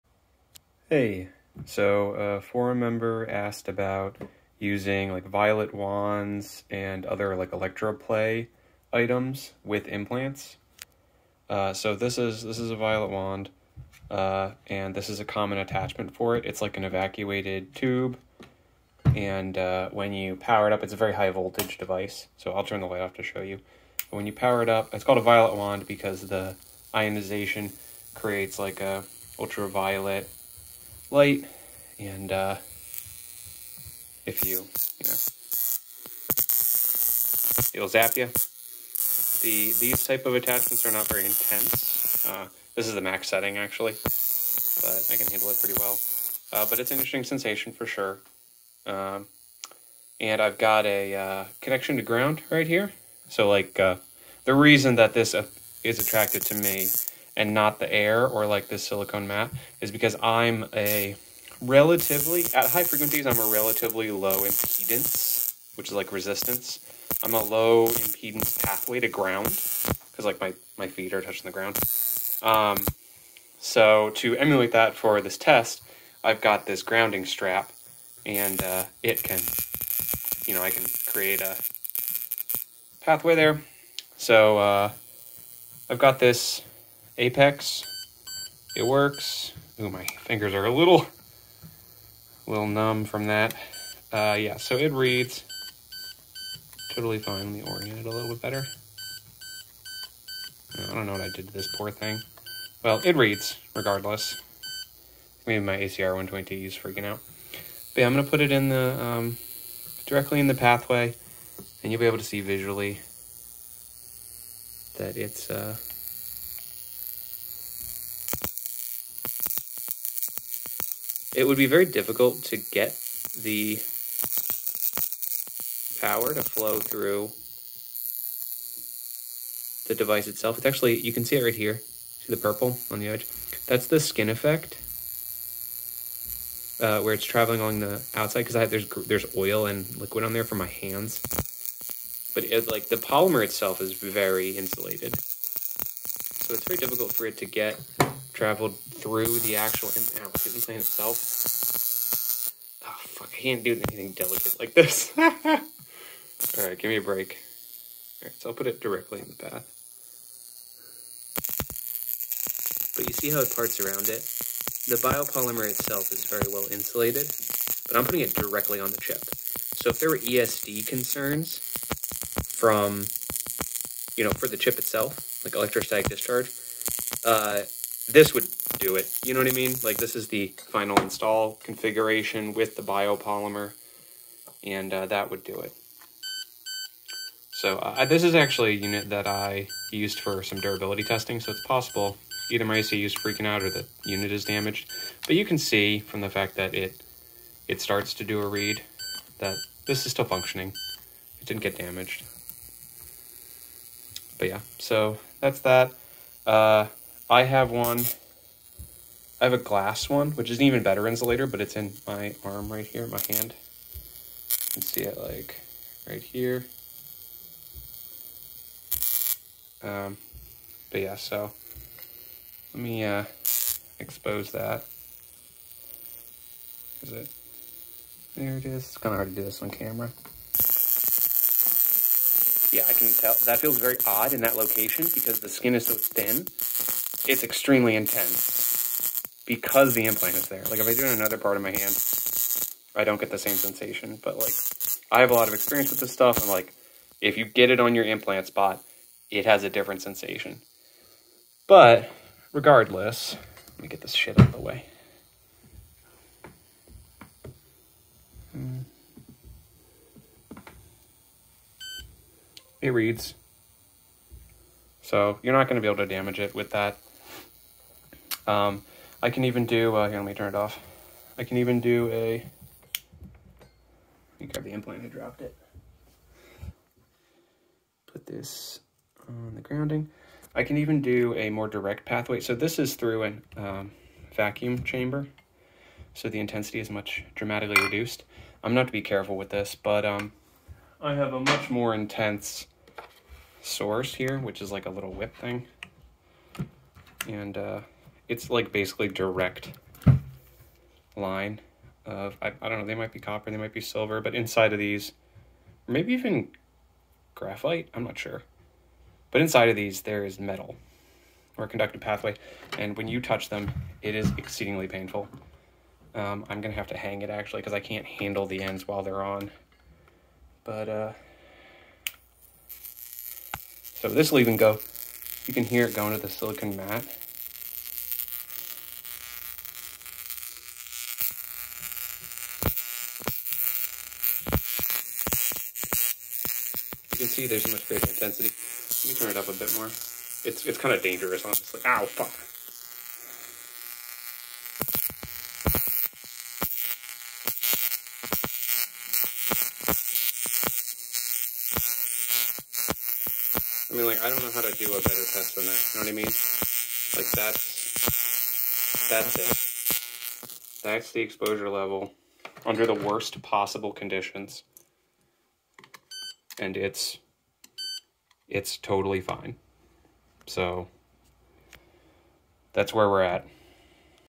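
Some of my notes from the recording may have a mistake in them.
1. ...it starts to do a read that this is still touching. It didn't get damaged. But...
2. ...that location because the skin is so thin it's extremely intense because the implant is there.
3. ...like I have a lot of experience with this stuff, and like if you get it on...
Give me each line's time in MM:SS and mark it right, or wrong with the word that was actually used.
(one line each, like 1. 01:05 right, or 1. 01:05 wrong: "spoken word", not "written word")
1. 03:17 wrong: "functioning", not "touching"
2. 03:54 right
3. 04:04 right.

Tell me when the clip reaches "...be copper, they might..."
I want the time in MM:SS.
05:03.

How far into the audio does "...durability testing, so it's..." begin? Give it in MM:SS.
03:10.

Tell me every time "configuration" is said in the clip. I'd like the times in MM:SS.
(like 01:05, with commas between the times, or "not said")
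03:01.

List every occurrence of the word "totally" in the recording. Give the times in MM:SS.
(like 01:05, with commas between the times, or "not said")
01:36, 06:08.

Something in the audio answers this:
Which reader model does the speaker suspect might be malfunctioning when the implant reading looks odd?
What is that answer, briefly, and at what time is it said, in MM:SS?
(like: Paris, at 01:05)
ACR 120, at 01:45.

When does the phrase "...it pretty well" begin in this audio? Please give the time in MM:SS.
00:45.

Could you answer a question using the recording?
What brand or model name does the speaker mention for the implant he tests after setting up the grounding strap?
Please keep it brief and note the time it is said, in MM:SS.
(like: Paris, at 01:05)
Apex, at 01:27.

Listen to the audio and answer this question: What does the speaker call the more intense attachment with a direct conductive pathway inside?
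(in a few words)
little whip thing.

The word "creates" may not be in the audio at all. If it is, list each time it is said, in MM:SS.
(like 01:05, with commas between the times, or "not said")
00:28, 01:21.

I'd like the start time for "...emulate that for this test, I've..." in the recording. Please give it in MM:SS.
01:14.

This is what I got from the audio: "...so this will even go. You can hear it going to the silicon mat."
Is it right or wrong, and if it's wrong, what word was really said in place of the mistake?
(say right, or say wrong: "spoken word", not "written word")
right.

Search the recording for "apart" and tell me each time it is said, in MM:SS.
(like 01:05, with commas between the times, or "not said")
not said.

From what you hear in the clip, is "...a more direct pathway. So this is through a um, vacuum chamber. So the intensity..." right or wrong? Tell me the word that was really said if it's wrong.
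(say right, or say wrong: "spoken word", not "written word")
right.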